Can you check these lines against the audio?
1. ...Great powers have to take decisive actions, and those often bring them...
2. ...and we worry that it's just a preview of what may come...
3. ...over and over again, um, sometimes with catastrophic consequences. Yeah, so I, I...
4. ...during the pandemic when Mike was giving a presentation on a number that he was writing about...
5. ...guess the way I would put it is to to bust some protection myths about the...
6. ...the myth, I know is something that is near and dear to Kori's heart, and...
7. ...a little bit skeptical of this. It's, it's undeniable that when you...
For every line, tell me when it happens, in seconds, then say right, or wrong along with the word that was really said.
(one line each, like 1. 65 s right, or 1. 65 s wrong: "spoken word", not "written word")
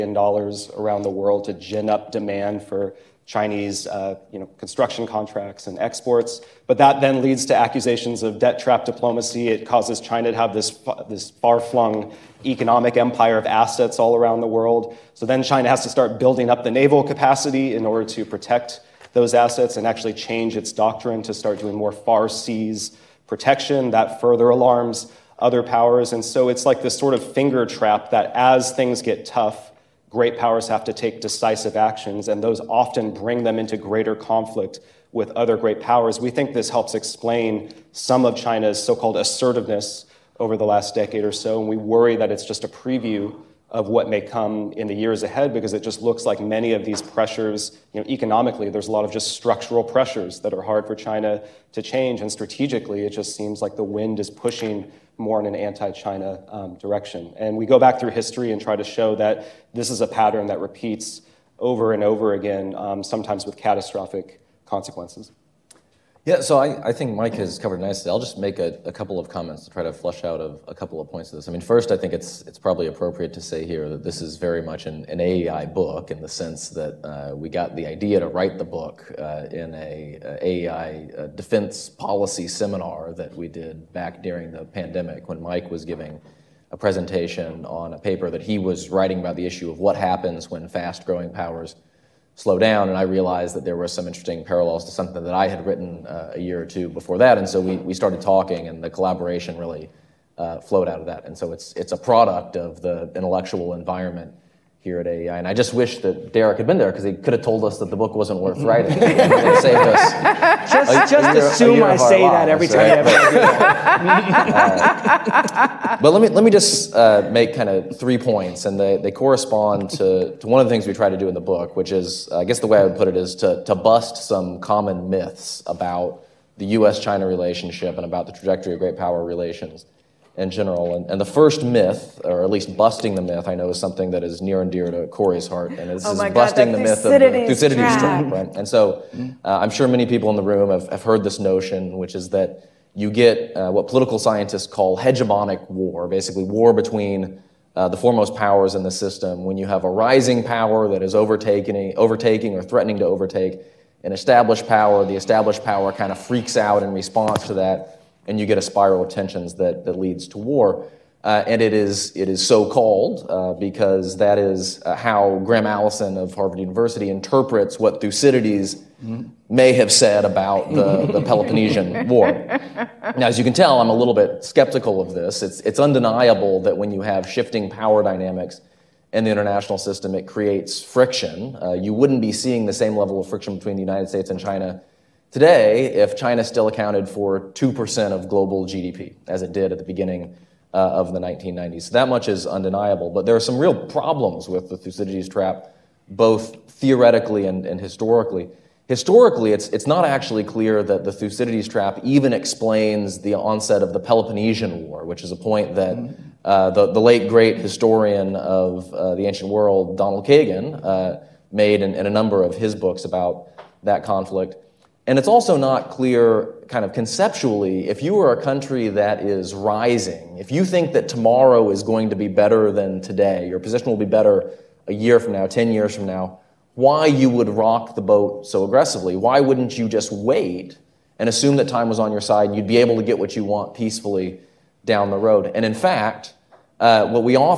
1. 30 s right
2. 41 s right
3. 61 s right
4. 84 s wrong: "paper", not "number"
5. 122 s wrong: "common", not "protection"
6. 133 s right
7. 173 s right.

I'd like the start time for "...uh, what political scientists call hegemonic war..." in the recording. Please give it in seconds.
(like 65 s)
143 s.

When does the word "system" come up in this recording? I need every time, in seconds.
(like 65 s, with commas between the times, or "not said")
148 s, 179 s.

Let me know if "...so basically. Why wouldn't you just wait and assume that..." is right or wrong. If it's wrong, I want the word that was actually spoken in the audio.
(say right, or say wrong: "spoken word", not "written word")
wrong: "aggressively", not "basically".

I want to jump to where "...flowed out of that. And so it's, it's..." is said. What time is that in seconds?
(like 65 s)
100 s.